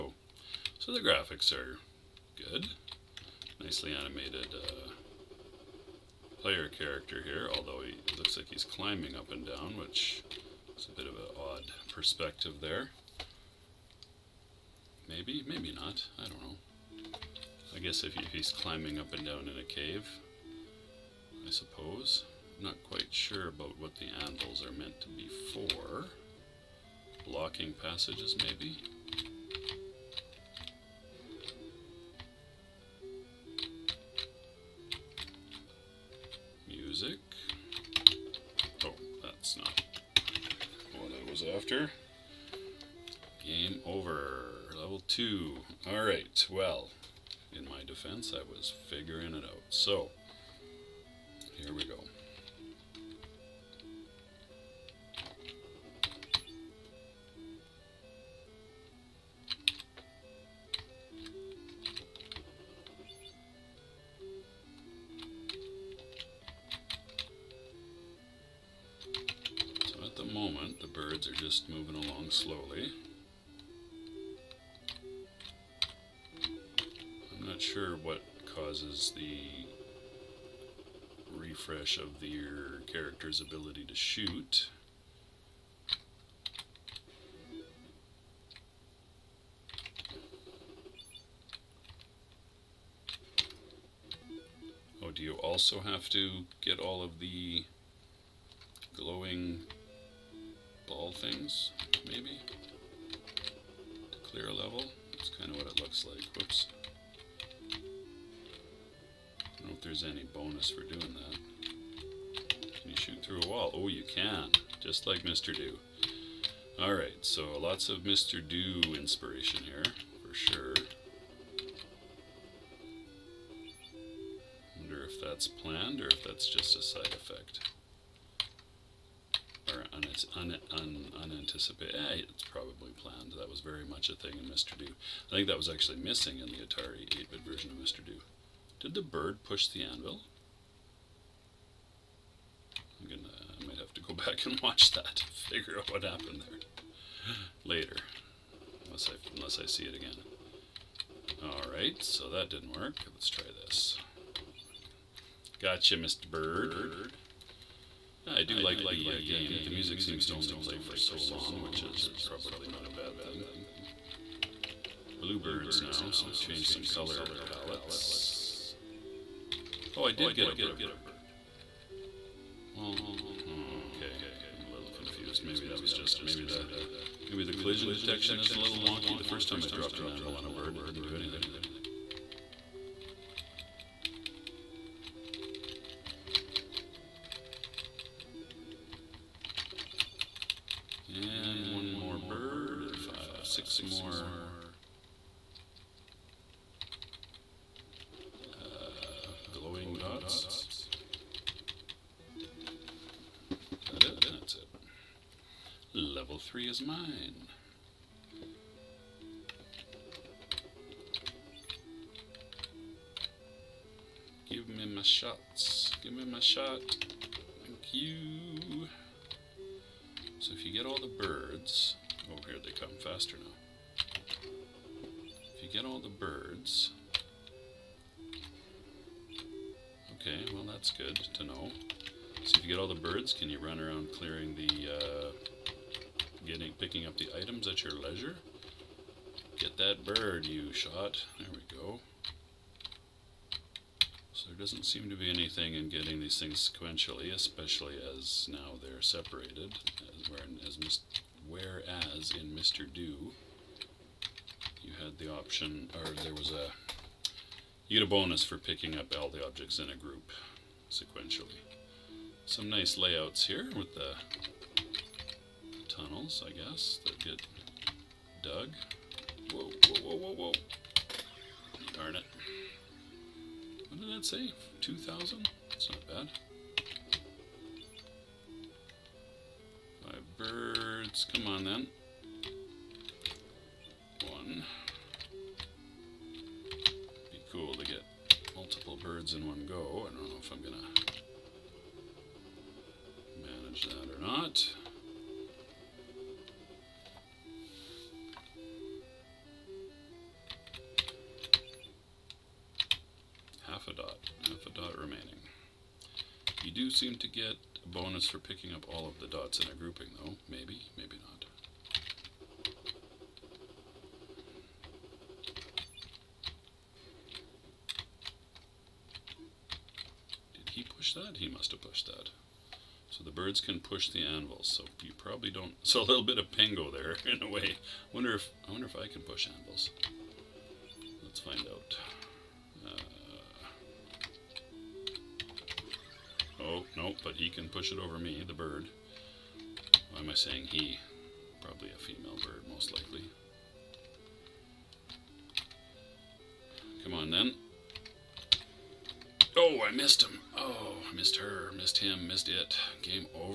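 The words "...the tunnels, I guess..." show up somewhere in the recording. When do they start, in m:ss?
4:23.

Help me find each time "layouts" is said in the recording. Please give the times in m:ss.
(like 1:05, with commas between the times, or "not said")
4:22.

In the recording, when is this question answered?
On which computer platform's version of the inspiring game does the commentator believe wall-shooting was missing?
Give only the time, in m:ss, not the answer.
2:16.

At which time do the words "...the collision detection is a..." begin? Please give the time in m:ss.
2:57.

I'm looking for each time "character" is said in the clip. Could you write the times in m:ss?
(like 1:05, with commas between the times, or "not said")
0:06, 1:22.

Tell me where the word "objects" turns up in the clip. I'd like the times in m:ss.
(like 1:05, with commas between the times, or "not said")
4:19.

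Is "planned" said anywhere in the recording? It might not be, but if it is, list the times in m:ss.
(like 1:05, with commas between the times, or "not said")
2:05, 2:12.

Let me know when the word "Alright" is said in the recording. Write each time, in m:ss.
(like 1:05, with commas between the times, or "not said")
1:56, 2:31.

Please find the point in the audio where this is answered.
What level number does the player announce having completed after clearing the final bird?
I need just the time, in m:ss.
3:25.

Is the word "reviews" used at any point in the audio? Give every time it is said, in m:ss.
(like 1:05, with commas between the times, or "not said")
not said.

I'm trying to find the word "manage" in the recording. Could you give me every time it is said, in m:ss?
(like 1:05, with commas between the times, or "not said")
4:53.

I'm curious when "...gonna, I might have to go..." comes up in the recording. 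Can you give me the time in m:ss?
2:23.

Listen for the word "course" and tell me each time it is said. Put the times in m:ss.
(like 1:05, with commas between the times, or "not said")
not said.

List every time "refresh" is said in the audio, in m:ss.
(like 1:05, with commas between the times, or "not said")
1:21.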